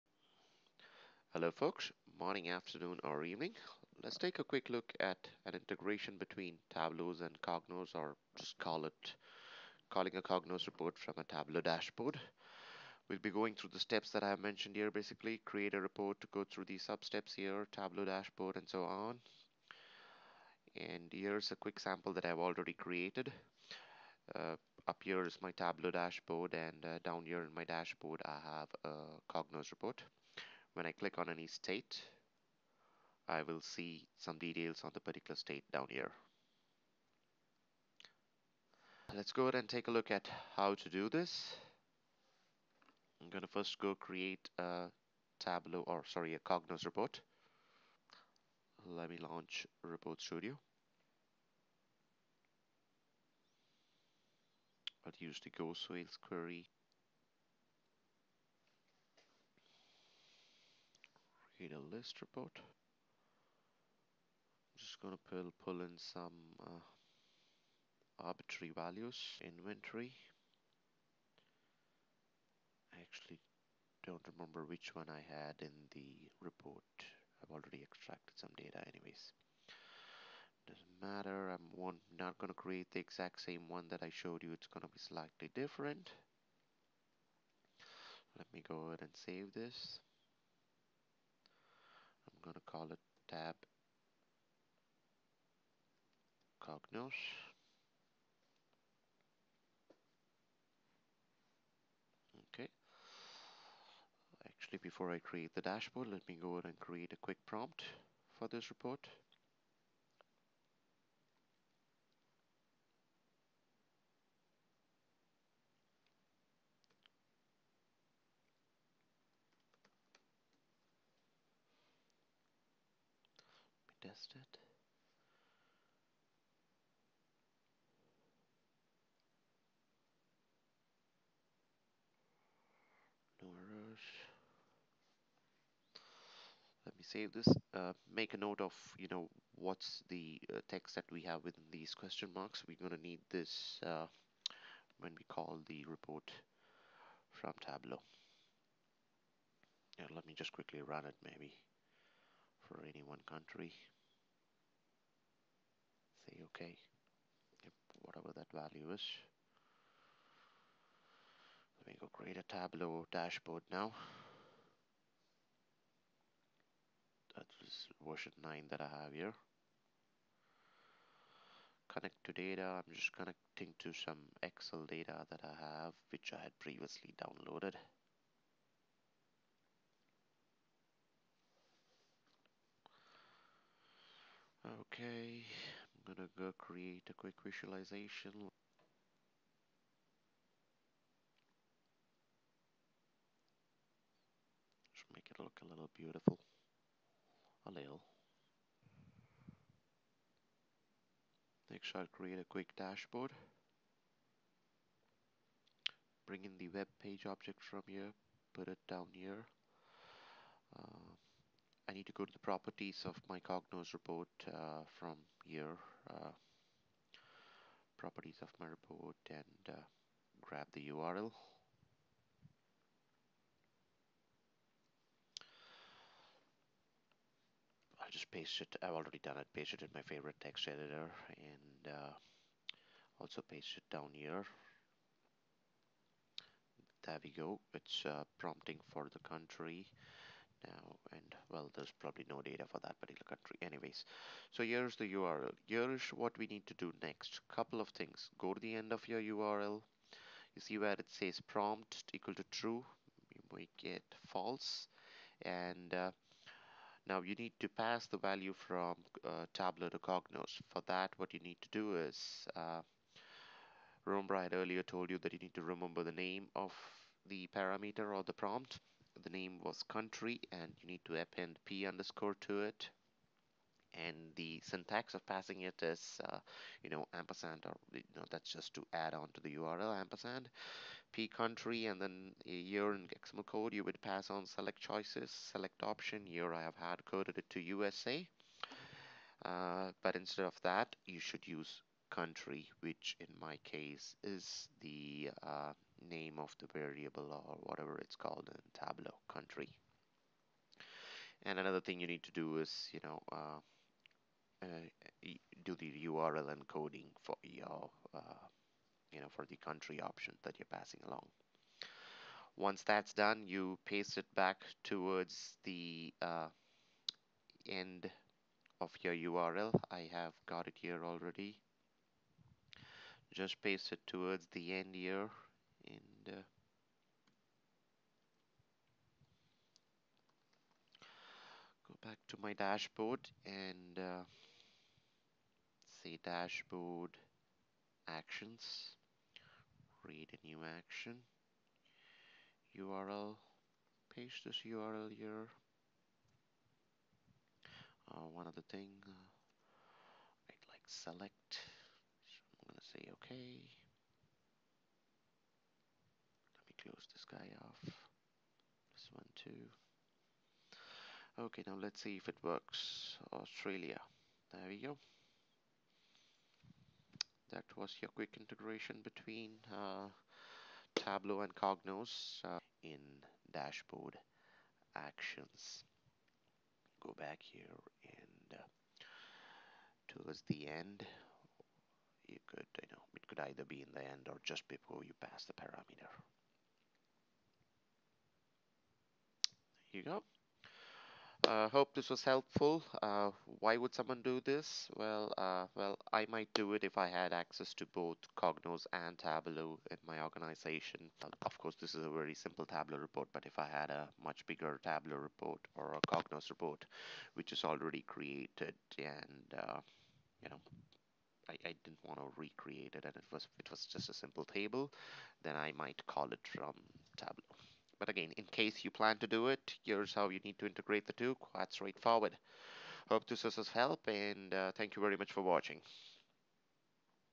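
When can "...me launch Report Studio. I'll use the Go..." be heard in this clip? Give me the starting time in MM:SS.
00:49.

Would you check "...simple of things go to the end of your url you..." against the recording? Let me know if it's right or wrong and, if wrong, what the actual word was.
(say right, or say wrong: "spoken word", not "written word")
wrong: "couple", not "simple".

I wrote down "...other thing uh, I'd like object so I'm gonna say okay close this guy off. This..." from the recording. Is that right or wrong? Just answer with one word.
wrong.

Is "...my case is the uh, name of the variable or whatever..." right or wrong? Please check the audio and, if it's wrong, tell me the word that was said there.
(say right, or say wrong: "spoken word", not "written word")
right.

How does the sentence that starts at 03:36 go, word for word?
Uh, properties of my report and uh, grab the URL.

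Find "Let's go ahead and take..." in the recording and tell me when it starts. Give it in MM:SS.
00:39.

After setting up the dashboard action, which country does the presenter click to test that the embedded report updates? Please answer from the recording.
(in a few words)
Australia.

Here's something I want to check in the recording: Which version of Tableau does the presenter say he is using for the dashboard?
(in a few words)
9.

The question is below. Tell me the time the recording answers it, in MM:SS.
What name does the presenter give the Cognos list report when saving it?
01:33.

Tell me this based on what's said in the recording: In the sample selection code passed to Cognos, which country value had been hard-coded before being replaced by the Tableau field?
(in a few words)
USA.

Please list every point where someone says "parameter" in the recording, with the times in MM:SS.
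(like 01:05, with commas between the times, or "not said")
04:27, 06:25.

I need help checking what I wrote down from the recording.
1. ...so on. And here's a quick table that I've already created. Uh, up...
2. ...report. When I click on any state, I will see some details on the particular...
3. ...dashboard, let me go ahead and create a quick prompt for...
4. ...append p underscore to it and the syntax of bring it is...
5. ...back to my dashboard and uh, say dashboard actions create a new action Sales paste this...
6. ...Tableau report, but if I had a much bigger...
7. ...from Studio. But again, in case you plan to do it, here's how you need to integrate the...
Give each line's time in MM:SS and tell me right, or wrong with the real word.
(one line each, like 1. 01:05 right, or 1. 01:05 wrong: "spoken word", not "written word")
1. 00:18 wrong: "sample", not "table"
2. 00:29 right
3. 01:45 right
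4. 04:31 wrong: "passing", not "bring"
5. 05:32 wrong: "URL", not "Sales"
6. 06:42 right
7. 06:56 wrong: "Tableau", not "Studio".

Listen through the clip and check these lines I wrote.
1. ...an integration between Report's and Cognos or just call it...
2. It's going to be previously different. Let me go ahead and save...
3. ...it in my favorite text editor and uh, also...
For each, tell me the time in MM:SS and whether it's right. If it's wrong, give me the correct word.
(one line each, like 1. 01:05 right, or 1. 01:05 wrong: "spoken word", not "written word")
1. 00:05 wrong: "Tableau", not "Report"
2. 01:24 wrong: "slightly", not "previously"
3. 03:49 right.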